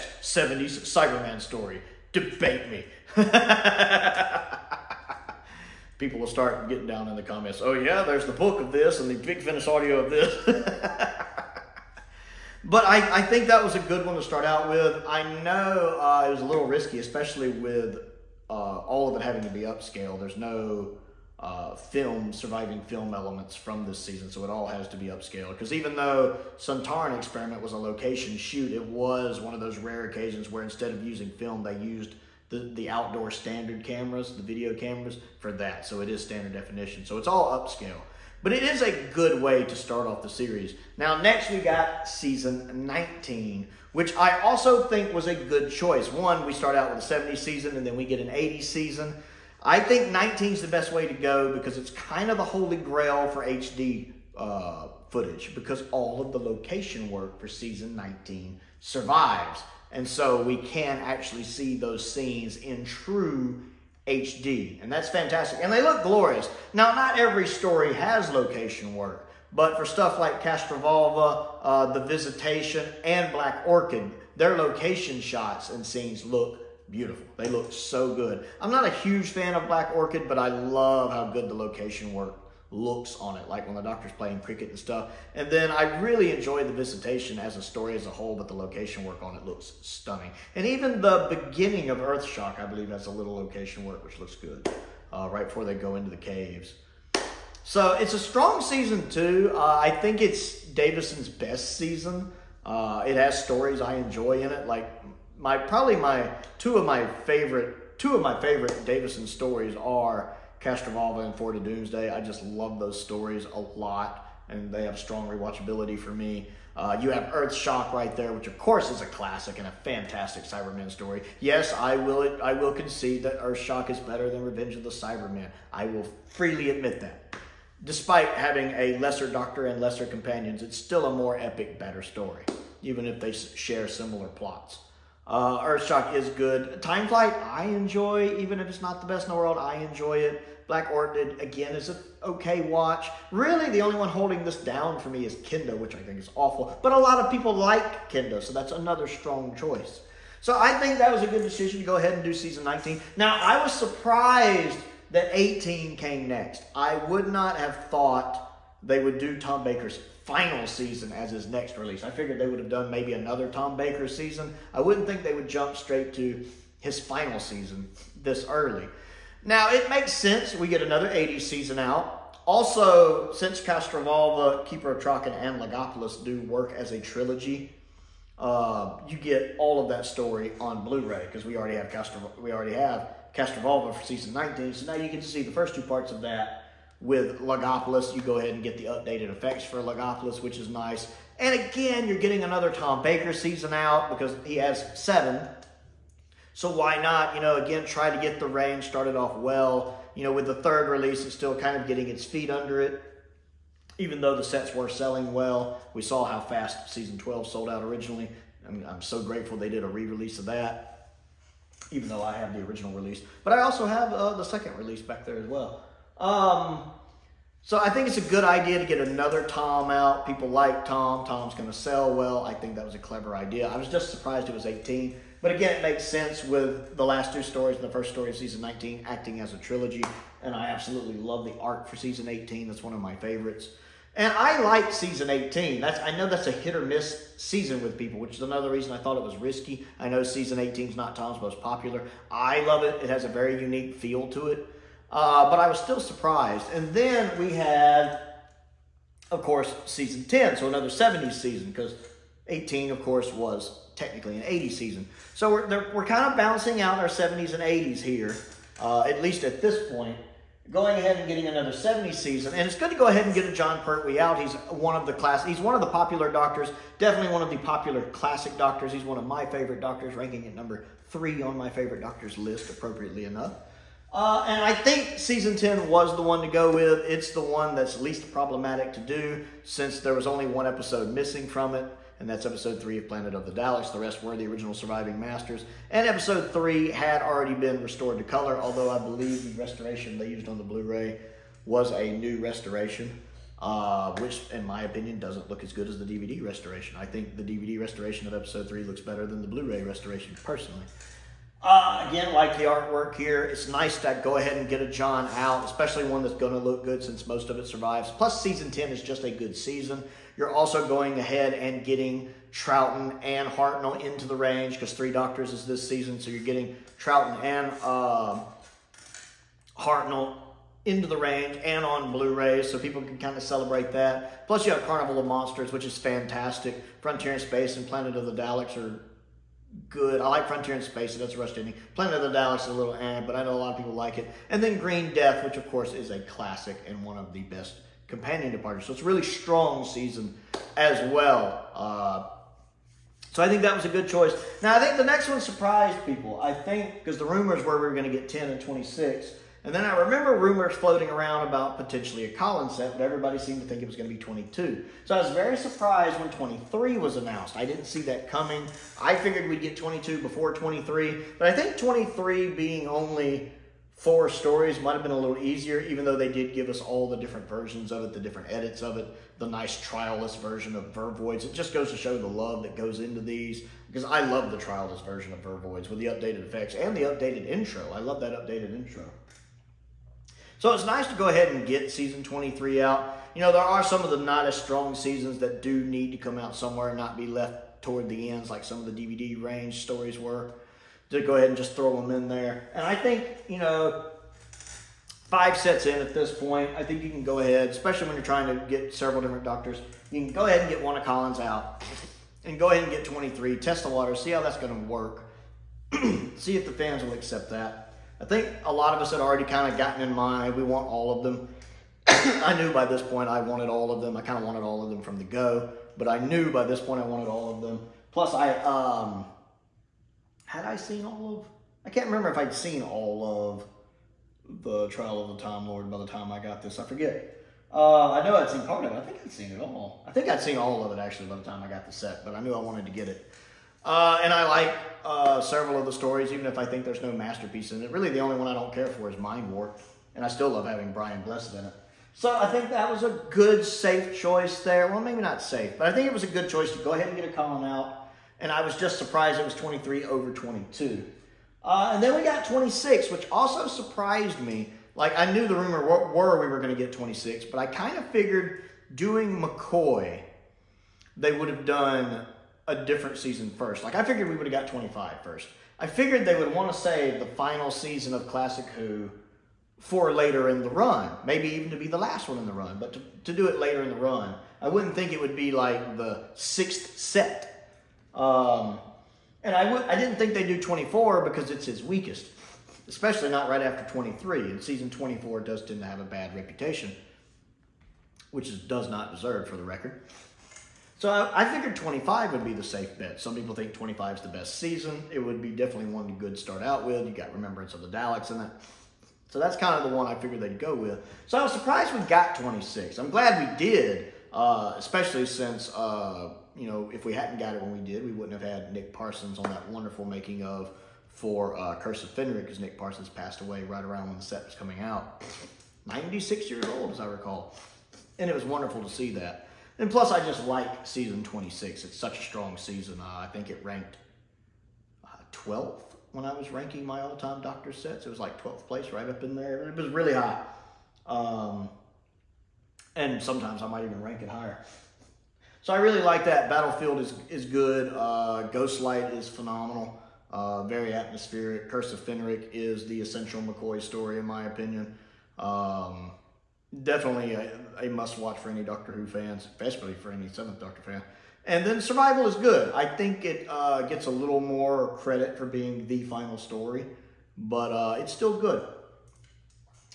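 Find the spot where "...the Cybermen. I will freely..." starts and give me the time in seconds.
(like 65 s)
124 s.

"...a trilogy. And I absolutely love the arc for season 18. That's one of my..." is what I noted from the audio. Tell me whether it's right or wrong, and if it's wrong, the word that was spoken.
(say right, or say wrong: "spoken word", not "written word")
right.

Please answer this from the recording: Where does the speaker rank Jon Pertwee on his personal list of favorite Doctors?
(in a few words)
Number 3.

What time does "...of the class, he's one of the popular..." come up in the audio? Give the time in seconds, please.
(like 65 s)
264 s.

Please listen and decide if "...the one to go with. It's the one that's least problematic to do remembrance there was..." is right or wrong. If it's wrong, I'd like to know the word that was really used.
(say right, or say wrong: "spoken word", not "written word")
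wrong: "since", not "remembrance".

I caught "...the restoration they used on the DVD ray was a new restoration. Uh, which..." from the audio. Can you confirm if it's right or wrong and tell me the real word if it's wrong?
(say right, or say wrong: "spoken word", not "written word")
wrong: "Blu", not "DVD".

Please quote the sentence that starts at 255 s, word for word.
So we're, we're kind of balancing out our 70s and 80s here, uh, at least at this point.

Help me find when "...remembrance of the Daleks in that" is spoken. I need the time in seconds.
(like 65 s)
497 s.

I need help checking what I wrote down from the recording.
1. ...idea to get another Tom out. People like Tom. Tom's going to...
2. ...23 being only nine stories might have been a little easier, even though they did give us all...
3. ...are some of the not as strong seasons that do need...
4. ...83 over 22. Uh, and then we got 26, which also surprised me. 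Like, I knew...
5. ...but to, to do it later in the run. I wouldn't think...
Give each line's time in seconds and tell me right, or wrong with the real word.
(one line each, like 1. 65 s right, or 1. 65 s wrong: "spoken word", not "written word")
1. 218 s right
2. 361 s wrong: "four", not "nine"
3. 383 s right
4. 449 s wrong: "23", not "83"
5. 472 s right.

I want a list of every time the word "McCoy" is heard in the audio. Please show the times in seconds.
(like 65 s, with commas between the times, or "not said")
459 s, 543 s.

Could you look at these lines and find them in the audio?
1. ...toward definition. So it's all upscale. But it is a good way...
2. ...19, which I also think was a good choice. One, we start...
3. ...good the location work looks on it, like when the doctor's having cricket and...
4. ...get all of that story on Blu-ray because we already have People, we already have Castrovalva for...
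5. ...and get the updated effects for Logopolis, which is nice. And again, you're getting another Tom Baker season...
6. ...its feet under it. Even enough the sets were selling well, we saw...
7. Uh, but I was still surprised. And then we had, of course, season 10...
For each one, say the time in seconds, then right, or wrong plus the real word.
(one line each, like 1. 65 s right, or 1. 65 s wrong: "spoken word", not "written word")
1. 36 s wrong: "standard", not "toward"
2. 42 s right
3. 81 s wrong: "playing", not "having"
4. 179 s wrong: "Castro", not "People"
5. 188 s right
6. 202 s wrong: "though", not "enough"
7. 245 s right.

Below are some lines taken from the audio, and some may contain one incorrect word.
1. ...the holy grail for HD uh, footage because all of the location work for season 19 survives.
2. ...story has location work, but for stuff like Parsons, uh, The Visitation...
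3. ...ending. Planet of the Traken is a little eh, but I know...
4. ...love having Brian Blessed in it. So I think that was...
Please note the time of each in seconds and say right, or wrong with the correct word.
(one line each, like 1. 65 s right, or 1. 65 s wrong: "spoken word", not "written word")
1. 52 s right
2. 67 s wrong: "Castrovalva", not "Parsons"
3. 331 s wrong: "Daleks", not "Traken"
4. 440 s right.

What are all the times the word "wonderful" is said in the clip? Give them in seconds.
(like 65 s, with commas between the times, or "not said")
509 s, 518 s.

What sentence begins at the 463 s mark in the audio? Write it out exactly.
Like I figured we would have got 25 first.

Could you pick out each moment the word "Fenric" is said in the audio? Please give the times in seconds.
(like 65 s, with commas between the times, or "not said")
512 s, 542 s.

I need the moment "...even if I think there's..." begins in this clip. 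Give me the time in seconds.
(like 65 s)
436 s.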